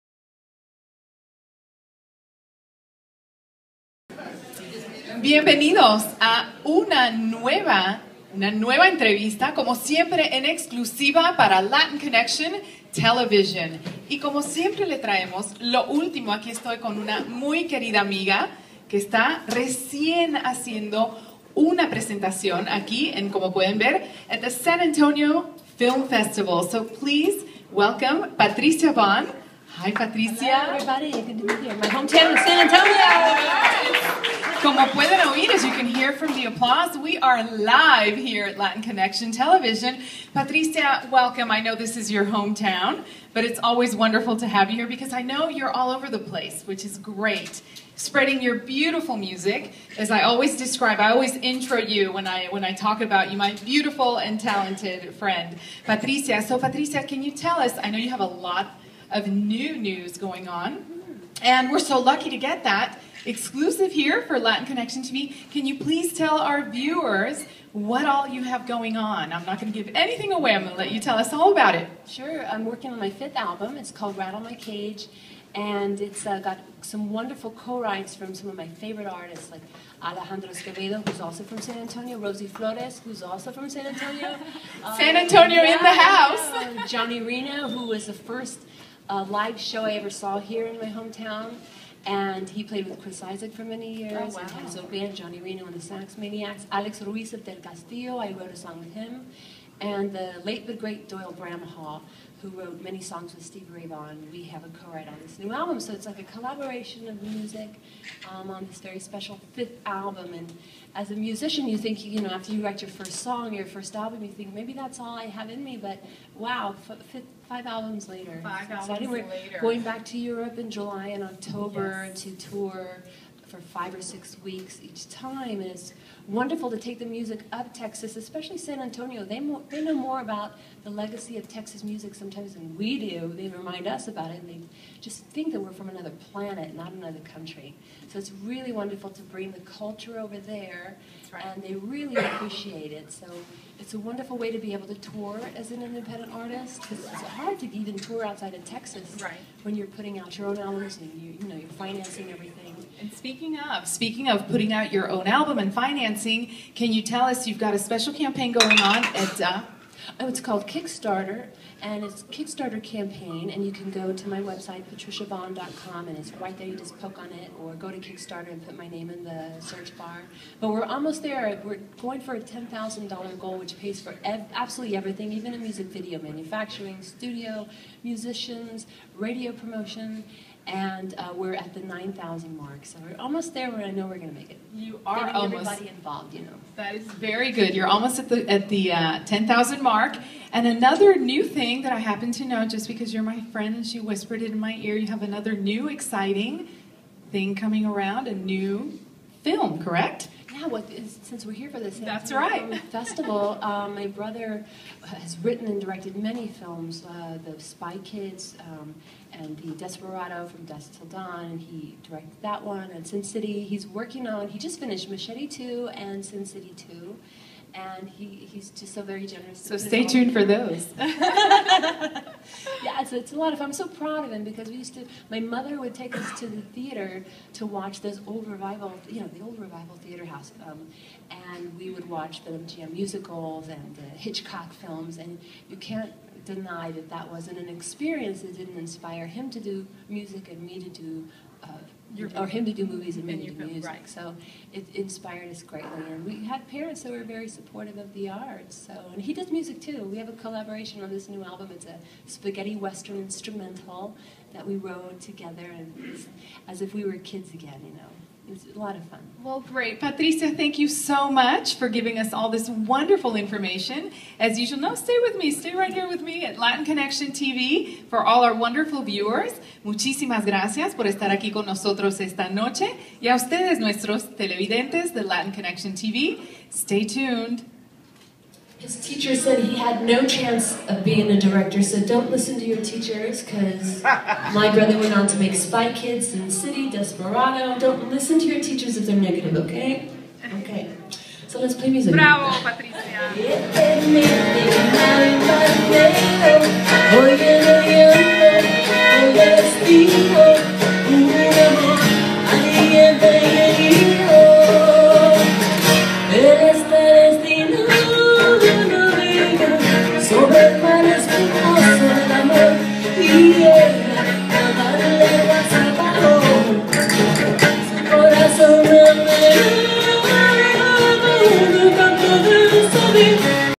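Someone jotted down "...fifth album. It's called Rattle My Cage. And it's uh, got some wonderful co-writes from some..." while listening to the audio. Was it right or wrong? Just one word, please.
right.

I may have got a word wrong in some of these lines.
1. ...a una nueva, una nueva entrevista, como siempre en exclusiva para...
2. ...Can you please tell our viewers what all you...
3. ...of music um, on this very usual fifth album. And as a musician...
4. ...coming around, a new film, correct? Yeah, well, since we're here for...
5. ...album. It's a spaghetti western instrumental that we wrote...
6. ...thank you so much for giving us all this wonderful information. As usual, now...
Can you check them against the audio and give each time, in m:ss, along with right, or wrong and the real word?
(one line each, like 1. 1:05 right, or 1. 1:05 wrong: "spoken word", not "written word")
1. 0:06 right
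2. 1:05 right
3. 1:47 wrong: "special", not "usual"
4. 3:17 right
5. 4:11 right
6. 4:20 right.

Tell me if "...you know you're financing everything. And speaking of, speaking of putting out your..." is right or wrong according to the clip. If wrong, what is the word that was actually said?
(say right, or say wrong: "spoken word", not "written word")
right.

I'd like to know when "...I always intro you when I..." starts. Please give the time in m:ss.
0:50.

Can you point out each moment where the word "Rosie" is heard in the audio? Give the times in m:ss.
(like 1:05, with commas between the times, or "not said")
1:22.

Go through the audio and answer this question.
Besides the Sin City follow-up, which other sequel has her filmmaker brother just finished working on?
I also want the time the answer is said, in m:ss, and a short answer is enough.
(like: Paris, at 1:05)
Machete 2, at 3:35.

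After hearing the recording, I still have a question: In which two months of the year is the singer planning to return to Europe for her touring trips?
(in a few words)
July and October.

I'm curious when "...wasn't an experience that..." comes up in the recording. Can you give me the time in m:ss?
3:57.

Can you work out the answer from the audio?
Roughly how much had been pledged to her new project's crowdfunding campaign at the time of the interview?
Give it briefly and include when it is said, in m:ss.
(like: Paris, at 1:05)
$9,000, at 3:01.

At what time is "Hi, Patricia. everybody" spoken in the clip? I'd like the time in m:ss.
0:29.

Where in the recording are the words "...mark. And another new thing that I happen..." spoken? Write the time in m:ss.
3:09.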